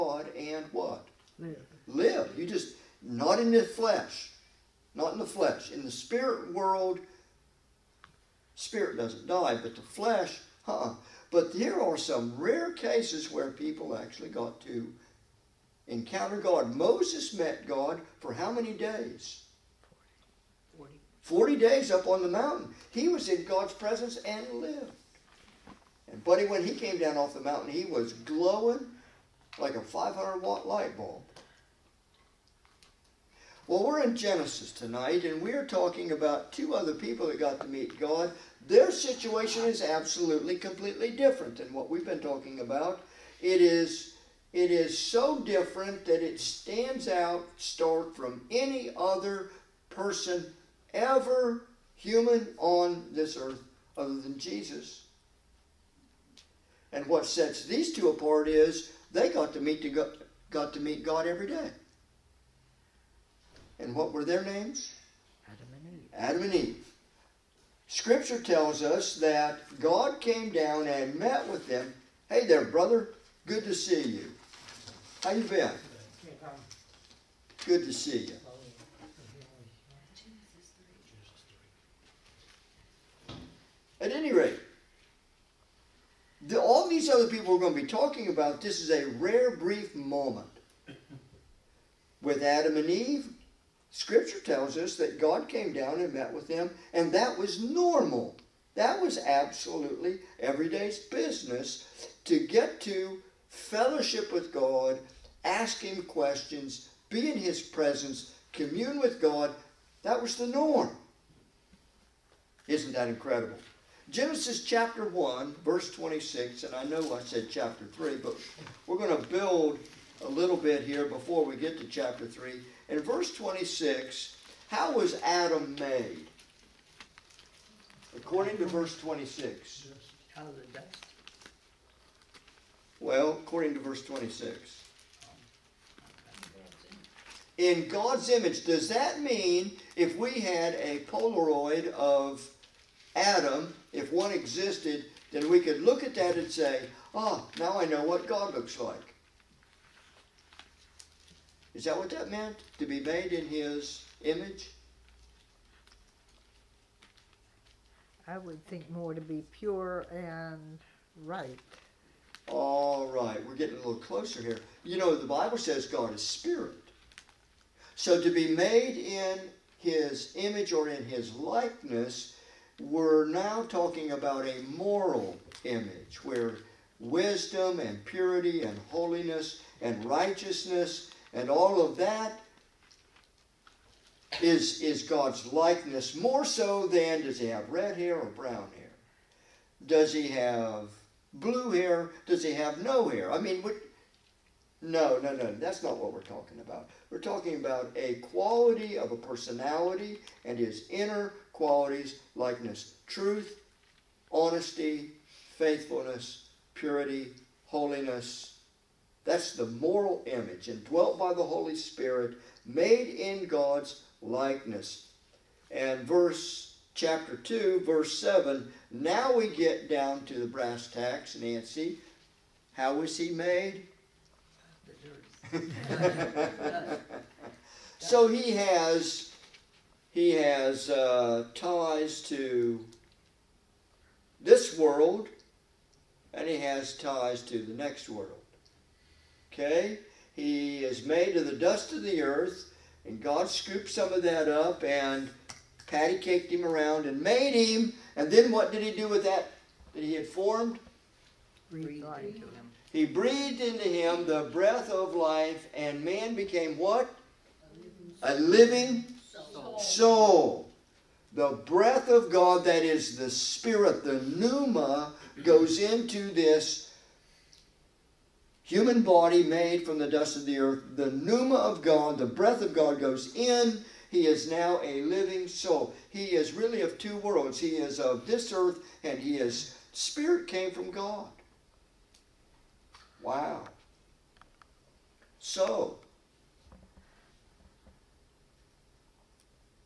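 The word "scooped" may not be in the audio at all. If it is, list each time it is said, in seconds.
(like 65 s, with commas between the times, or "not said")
243 s.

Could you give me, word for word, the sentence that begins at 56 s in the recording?
And what sets these two apart is they got to meet to go, got to meet God every day.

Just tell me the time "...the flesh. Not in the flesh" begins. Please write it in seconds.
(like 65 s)
3 s.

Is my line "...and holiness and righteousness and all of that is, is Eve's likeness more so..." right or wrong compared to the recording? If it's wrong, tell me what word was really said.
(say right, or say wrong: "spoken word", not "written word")
wrong: "God", not "Eve".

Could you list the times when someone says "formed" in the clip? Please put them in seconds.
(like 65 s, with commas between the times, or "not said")
250 s.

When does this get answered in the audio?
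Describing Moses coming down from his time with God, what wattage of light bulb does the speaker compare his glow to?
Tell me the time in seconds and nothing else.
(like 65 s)
29 s.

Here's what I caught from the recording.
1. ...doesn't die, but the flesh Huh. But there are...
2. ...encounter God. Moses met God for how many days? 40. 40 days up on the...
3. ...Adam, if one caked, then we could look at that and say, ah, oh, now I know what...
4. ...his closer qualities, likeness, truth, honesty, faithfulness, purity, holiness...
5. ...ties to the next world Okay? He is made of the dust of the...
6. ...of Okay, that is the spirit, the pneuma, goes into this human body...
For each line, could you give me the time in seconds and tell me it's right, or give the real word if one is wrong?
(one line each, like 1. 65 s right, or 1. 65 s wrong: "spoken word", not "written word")
1. 8 s right
2. 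15 s right
3. 143 s wrong: "existed", not "caked"
4. 200 s wrong: "inner", not "closer"
5. 236 s right
6. 262 s wrong: "God", not "Okay".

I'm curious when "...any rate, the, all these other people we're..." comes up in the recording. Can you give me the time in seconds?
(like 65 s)
84 s.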